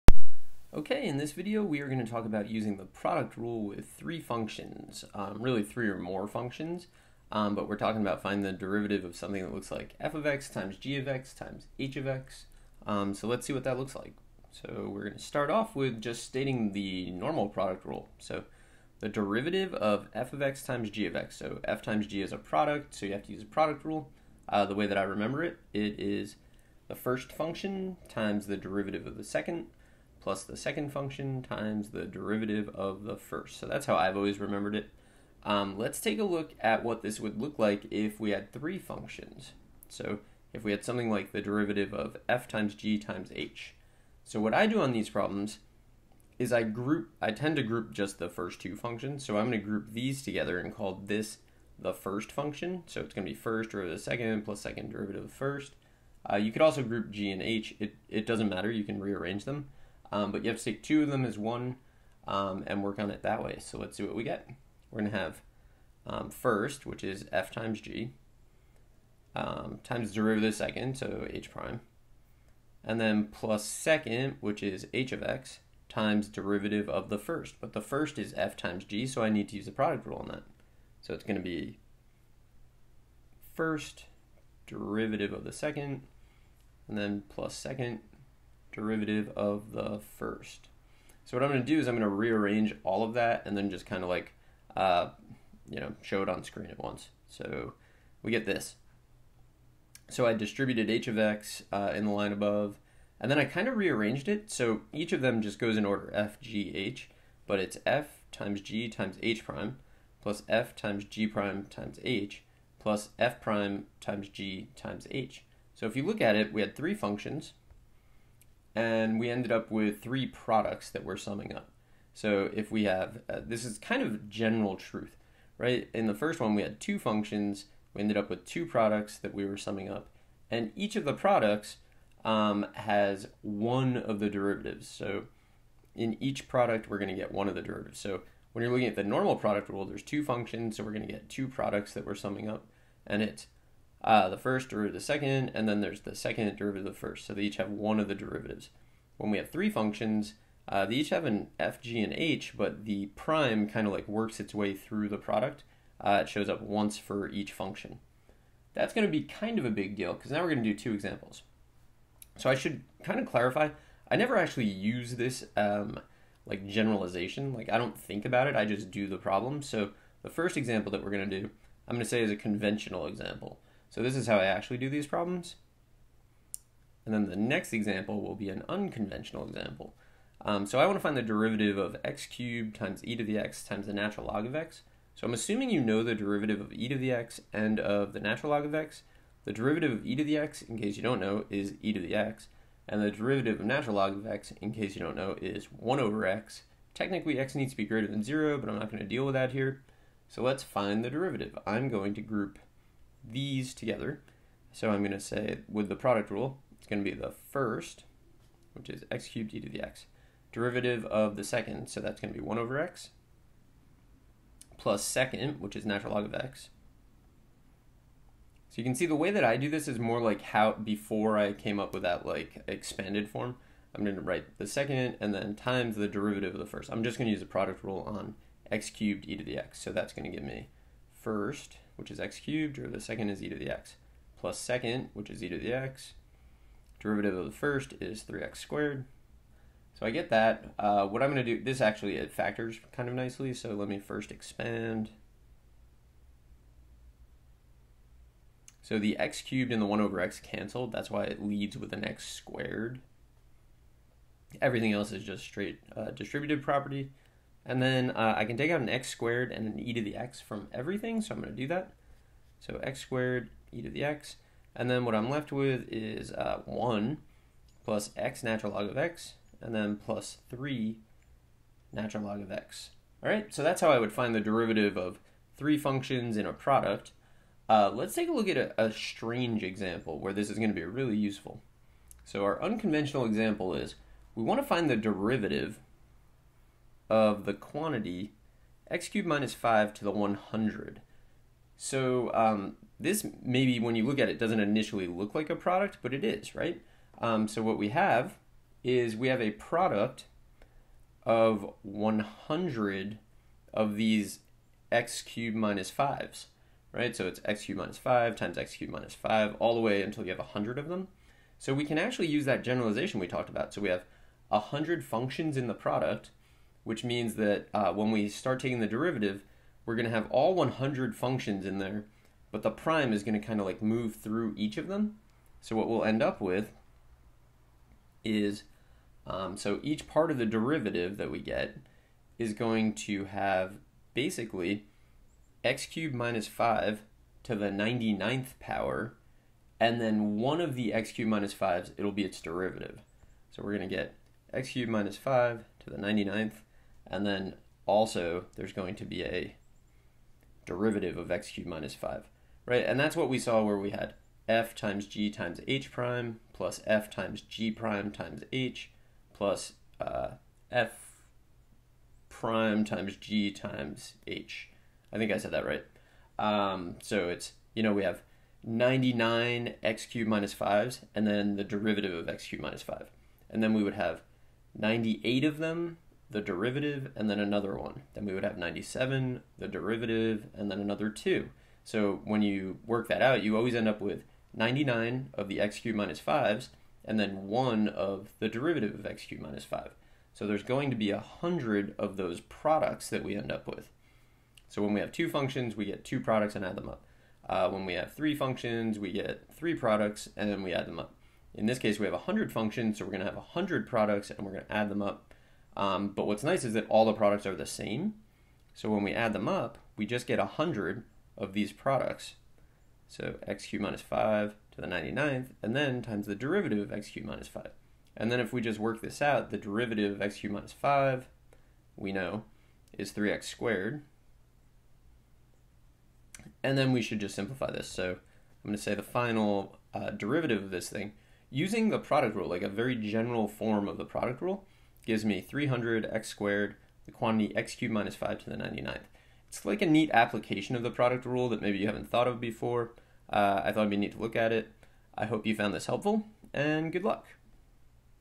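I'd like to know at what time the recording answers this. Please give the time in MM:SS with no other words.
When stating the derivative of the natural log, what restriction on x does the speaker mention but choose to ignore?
03:17.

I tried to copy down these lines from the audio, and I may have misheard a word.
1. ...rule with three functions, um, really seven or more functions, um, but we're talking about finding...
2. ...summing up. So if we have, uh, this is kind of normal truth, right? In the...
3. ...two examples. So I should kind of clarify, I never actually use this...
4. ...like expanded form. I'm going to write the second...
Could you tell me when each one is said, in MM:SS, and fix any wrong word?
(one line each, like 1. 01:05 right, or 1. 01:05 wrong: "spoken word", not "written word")
1. 00:03 wrong: "three", not "seven"
2. 02:01 wrong: "general", not "normal"
3. 02:40 right
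4. 03:42 right.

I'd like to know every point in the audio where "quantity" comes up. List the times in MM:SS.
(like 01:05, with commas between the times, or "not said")
04:47, 07:17.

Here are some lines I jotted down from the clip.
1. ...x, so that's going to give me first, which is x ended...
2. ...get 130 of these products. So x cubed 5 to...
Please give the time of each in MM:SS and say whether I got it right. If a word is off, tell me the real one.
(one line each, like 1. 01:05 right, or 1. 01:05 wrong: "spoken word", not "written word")
1. 03:49 wrong: "cubed", not "ended"
2. 06:50 wrong: "100", not "130".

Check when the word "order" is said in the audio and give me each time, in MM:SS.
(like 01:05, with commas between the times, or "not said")
01:45.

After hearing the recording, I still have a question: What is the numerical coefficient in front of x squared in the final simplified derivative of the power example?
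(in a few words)
300.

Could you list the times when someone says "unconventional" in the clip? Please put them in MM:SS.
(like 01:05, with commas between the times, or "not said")
02:58, 04:42.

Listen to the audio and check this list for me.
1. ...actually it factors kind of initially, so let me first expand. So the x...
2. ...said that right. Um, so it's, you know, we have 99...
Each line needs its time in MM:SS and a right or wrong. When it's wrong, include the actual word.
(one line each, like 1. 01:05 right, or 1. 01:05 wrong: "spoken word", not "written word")
1. 04:01 wrong: "nicely", not "initially"
2. 06:05 right.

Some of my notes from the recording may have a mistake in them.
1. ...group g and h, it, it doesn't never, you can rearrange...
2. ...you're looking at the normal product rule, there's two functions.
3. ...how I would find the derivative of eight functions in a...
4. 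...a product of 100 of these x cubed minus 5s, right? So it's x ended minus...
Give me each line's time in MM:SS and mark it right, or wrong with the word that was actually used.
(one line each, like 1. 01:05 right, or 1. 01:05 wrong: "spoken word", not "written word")
1. 00:56 wrong: "matter", not "never"
2. 02:18 right
3. 04:33 wrong: "three", not "eight"
4. 04:59 wrong: "cubed", not "ended".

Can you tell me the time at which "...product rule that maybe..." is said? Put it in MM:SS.
07:20.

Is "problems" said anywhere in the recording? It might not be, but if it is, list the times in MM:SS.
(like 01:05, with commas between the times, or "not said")
00:45, 02:49, 02:55.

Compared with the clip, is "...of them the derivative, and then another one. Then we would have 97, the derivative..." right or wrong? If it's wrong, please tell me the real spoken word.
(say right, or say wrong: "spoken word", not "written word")
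right.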